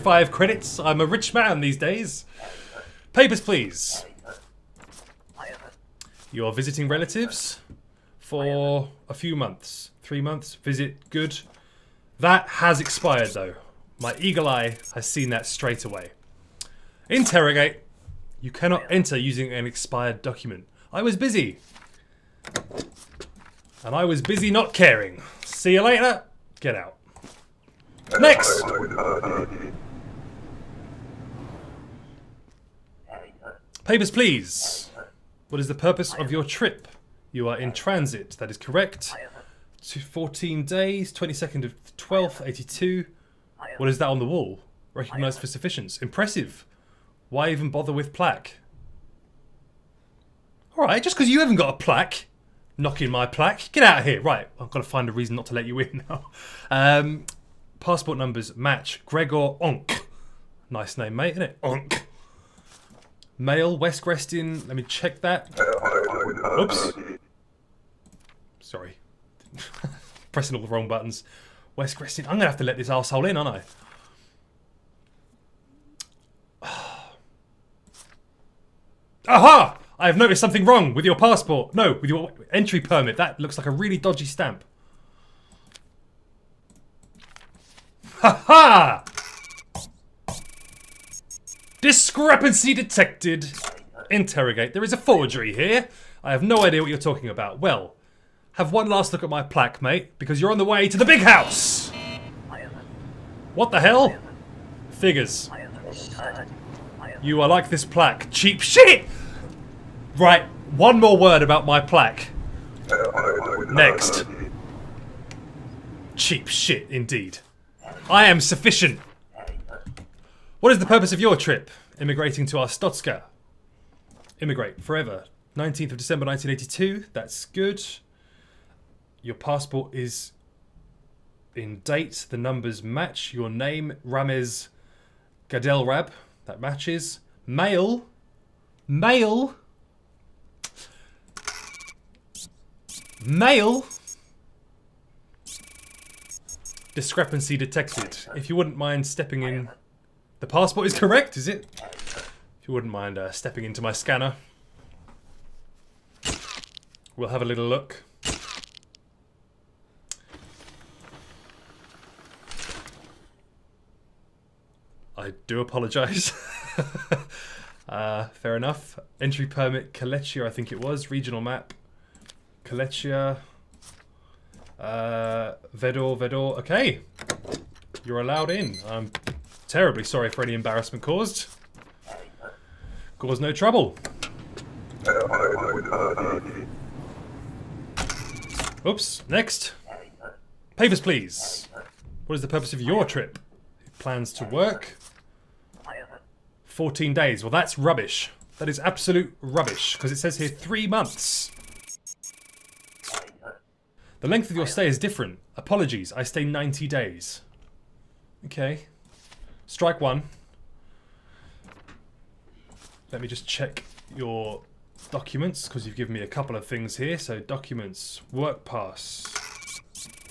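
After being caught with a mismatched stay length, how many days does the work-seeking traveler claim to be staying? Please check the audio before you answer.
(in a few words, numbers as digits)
90 days.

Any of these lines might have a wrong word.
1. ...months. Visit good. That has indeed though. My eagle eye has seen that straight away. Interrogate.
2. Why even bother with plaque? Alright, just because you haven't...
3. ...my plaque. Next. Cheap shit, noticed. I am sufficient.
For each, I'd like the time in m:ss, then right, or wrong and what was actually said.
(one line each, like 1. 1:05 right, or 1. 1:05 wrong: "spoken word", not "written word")
1. 0:10 wrong: "expired", not "indeed"
2. 0:47 right
3. 1:51 wrong: "indeed", not "noticed".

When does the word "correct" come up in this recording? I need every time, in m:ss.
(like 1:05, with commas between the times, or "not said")
0:38, 2:30.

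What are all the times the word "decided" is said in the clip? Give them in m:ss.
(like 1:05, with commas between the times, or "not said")
not said.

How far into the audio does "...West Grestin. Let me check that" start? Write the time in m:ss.
1:03.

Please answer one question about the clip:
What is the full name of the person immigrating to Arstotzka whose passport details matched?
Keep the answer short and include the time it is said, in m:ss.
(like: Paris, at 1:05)
Rames Gadelrab, at 2:14.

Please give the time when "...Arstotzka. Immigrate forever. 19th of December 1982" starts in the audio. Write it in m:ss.
2:02.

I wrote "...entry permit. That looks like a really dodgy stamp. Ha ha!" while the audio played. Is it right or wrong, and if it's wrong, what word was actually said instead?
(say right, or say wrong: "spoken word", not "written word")
right.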